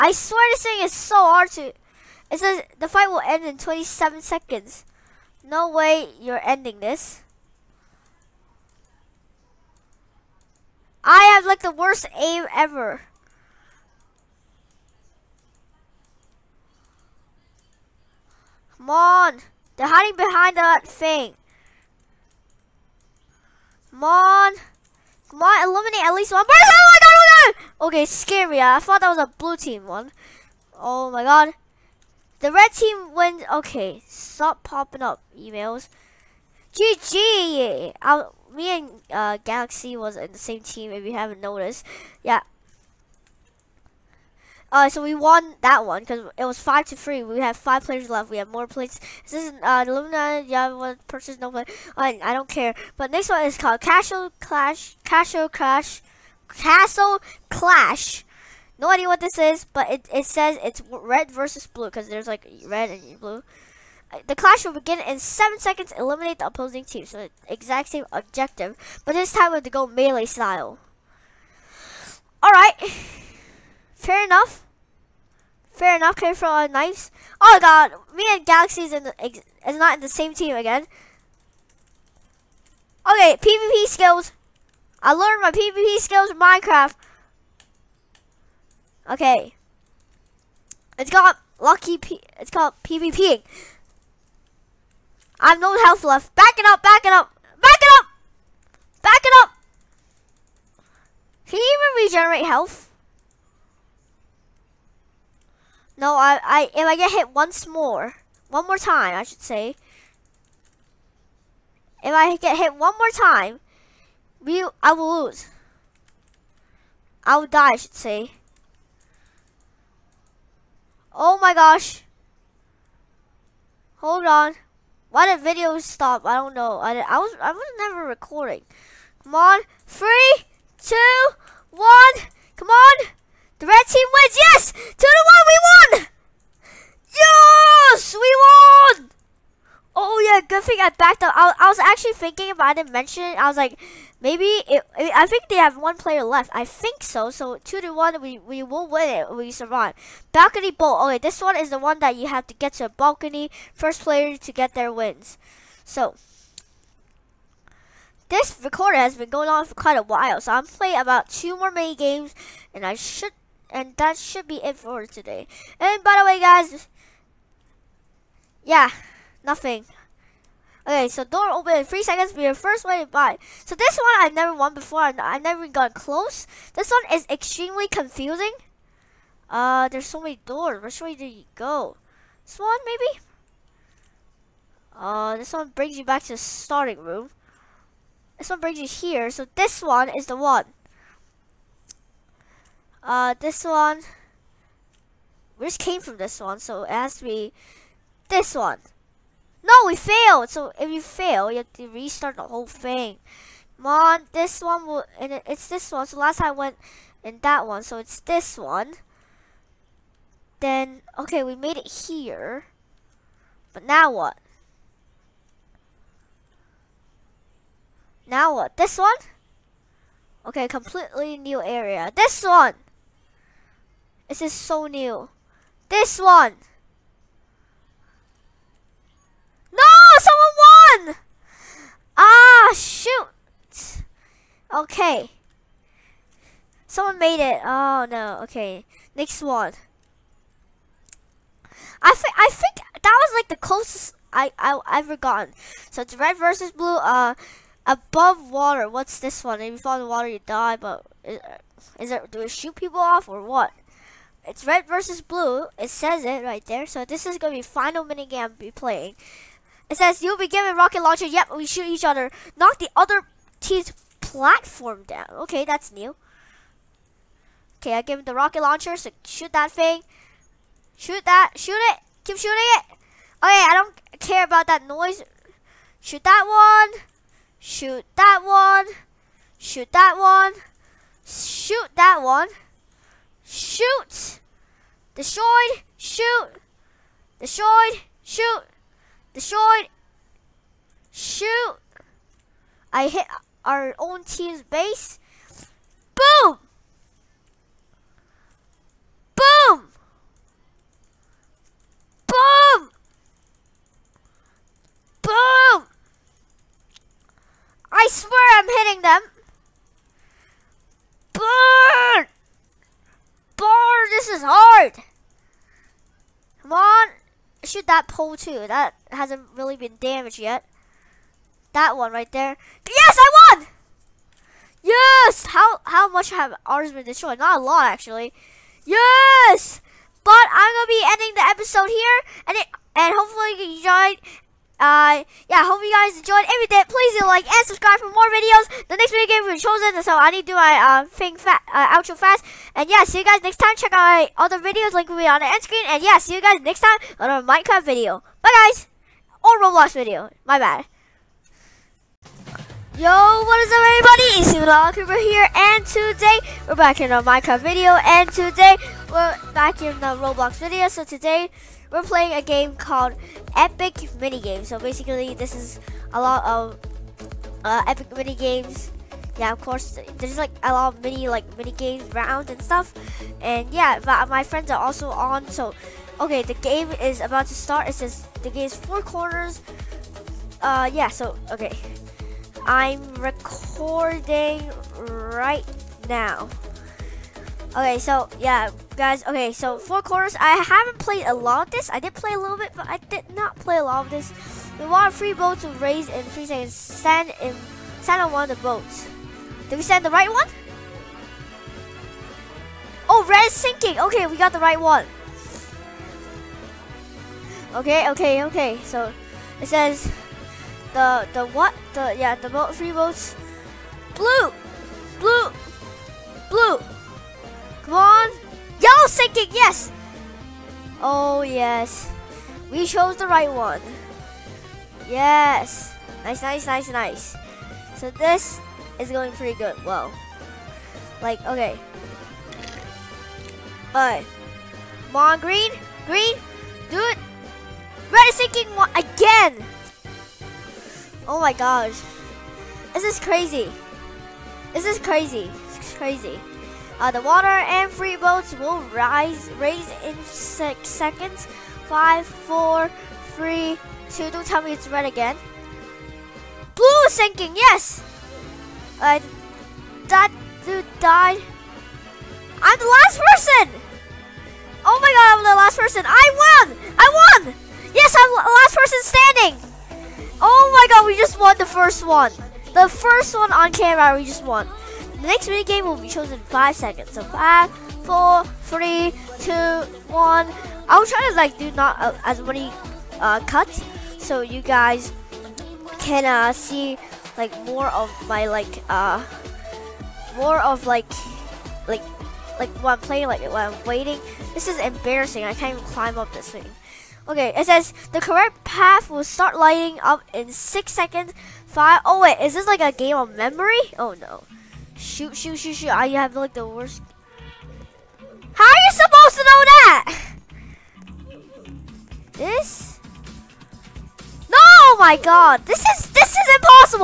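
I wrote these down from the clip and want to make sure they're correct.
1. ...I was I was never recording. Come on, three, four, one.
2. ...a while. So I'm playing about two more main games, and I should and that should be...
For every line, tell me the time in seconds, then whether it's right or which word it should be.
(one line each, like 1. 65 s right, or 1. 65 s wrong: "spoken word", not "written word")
1. 127 s wrong: "two", not "four"
2. 159 s right.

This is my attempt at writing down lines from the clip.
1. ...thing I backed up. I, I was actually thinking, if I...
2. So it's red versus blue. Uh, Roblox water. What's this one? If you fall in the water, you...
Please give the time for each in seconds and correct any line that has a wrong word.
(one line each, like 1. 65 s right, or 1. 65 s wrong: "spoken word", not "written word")
1. 140 s right
2. 245 s wrong: "Above", not "Roblox".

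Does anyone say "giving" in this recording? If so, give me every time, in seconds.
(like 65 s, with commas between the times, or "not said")
not said.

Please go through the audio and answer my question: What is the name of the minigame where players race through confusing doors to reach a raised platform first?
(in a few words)
Balcony bolt.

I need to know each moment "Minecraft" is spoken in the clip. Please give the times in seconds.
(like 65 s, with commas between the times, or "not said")
86 s, 347 s, 357 s.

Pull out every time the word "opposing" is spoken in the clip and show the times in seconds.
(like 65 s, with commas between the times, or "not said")
66 s.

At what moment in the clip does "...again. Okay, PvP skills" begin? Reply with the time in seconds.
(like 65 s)
80 s.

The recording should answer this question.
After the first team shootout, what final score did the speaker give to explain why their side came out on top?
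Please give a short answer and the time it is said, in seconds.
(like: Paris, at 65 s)
5 to 3, at 46 s.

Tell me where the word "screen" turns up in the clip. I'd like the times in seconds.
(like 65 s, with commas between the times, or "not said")
345 s.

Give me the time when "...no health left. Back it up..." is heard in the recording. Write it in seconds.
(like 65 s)
95 s.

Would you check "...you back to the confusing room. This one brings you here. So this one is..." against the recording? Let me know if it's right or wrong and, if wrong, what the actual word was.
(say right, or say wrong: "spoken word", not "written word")
wrong: "starting", not "confusing".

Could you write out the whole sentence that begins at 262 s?
Knock the other team's platform down.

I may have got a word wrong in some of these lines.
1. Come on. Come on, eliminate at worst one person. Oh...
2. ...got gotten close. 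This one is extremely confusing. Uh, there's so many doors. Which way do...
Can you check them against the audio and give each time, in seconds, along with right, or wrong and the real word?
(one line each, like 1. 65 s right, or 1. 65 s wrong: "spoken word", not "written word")
1. 23 s wrong: "least", not "worst"
2. 175 s right.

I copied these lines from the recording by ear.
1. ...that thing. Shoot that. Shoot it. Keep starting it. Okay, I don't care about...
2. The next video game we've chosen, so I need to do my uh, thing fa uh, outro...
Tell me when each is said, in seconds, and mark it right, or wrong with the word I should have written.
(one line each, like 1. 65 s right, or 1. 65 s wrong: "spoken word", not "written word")
1. 269 s wrong: "shooting", not "starting"
2. 338 s right.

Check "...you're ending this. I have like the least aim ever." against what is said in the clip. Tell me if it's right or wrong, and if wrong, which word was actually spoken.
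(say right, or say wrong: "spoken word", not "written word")
wrong: "worst", not "least".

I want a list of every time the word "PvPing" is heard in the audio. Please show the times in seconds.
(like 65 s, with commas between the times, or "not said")
92 s.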